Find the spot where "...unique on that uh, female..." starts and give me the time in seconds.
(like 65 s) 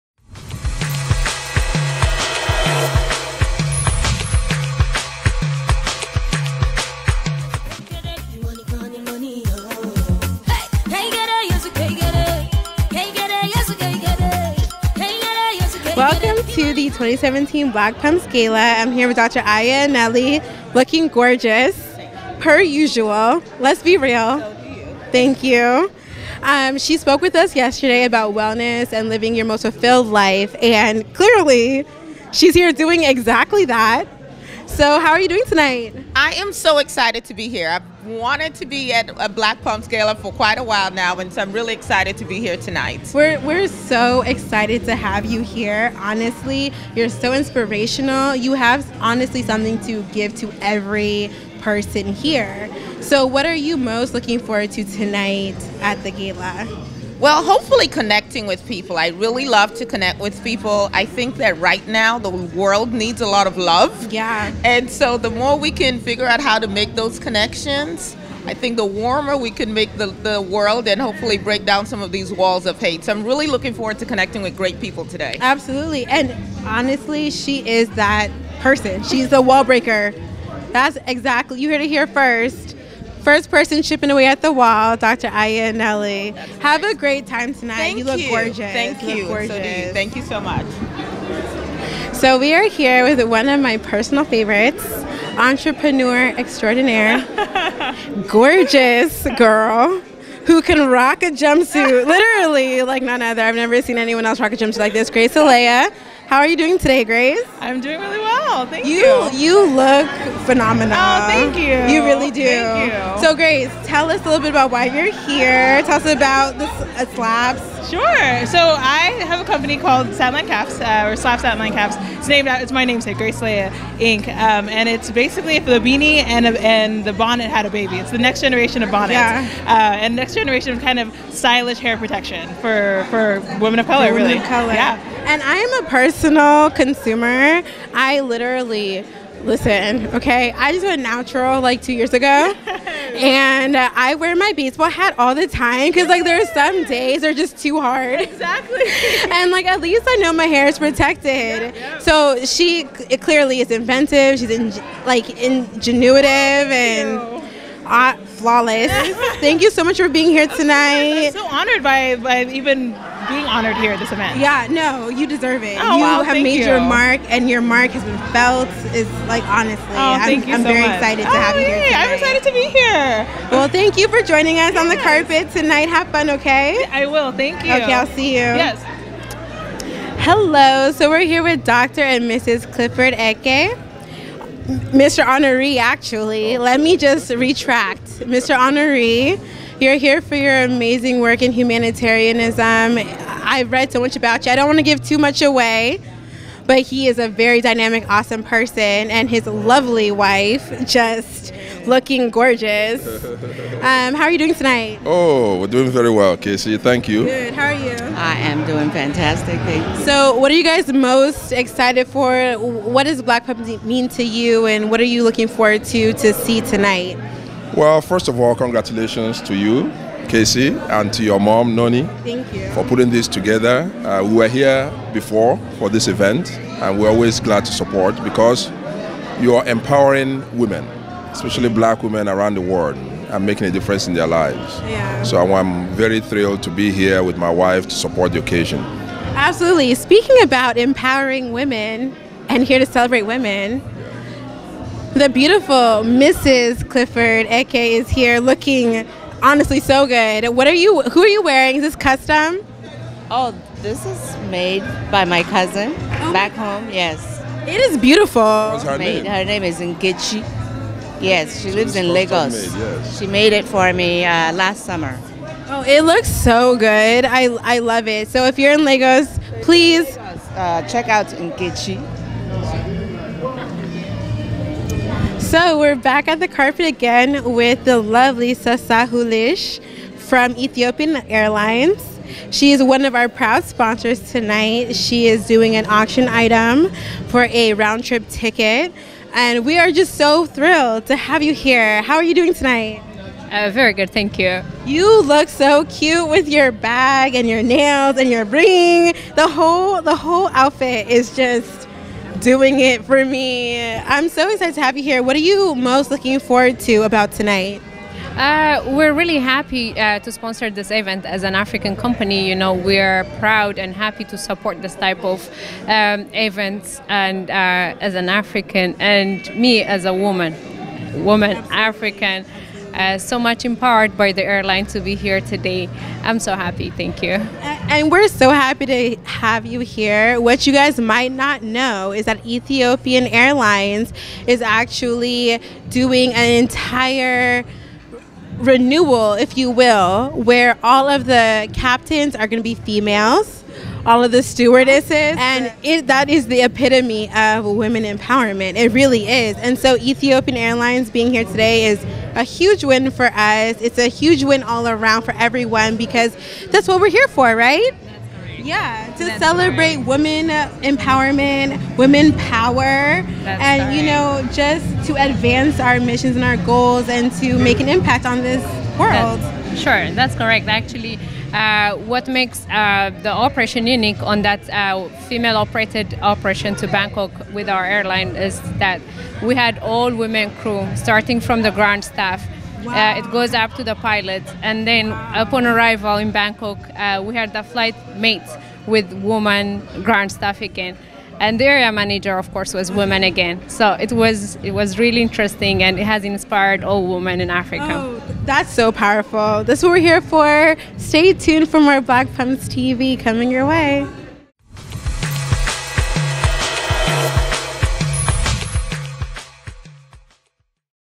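373 s.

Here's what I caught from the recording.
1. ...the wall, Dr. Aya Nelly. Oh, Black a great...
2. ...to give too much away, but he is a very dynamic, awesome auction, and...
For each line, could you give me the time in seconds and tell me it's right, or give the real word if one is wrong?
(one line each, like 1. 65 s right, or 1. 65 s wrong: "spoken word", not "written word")
1. 84 s wrong: "Have", not "Black"
2. 194 s wrong: "person", not "auction".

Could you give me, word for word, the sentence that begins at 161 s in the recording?
I'm so honored by, by even being honored here at this event.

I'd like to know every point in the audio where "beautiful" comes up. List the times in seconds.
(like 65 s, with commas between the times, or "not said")
245 s, 257 s.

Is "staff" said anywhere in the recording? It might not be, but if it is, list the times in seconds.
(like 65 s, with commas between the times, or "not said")
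382 s, 390 s.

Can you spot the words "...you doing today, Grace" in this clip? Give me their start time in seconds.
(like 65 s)
106 s.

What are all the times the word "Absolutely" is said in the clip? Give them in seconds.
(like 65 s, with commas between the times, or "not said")
75 s, 239 s.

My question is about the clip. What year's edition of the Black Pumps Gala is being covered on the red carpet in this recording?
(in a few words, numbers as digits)
2017.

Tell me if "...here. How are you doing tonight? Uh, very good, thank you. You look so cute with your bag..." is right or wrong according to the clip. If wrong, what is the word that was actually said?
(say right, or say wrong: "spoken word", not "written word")
right.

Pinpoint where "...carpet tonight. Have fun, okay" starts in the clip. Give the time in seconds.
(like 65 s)
174 s.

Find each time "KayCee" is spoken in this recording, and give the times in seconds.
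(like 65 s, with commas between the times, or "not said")
206 s, 220 s.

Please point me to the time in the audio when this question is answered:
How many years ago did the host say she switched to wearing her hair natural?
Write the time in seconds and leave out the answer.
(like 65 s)
141 s.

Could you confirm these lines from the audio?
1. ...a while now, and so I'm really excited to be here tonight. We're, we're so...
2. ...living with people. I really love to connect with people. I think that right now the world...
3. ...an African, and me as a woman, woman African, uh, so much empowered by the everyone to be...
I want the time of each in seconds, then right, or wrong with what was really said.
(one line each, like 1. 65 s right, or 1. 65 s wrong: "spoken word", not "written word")
1. 40 s right
2. 57 s wrong: "connecting", not "living"
3. 318 s wrong: "airline", not "everyone".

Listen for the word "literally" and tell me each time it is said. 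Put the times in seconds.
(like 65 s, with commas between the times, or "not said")
102 s, 138 s.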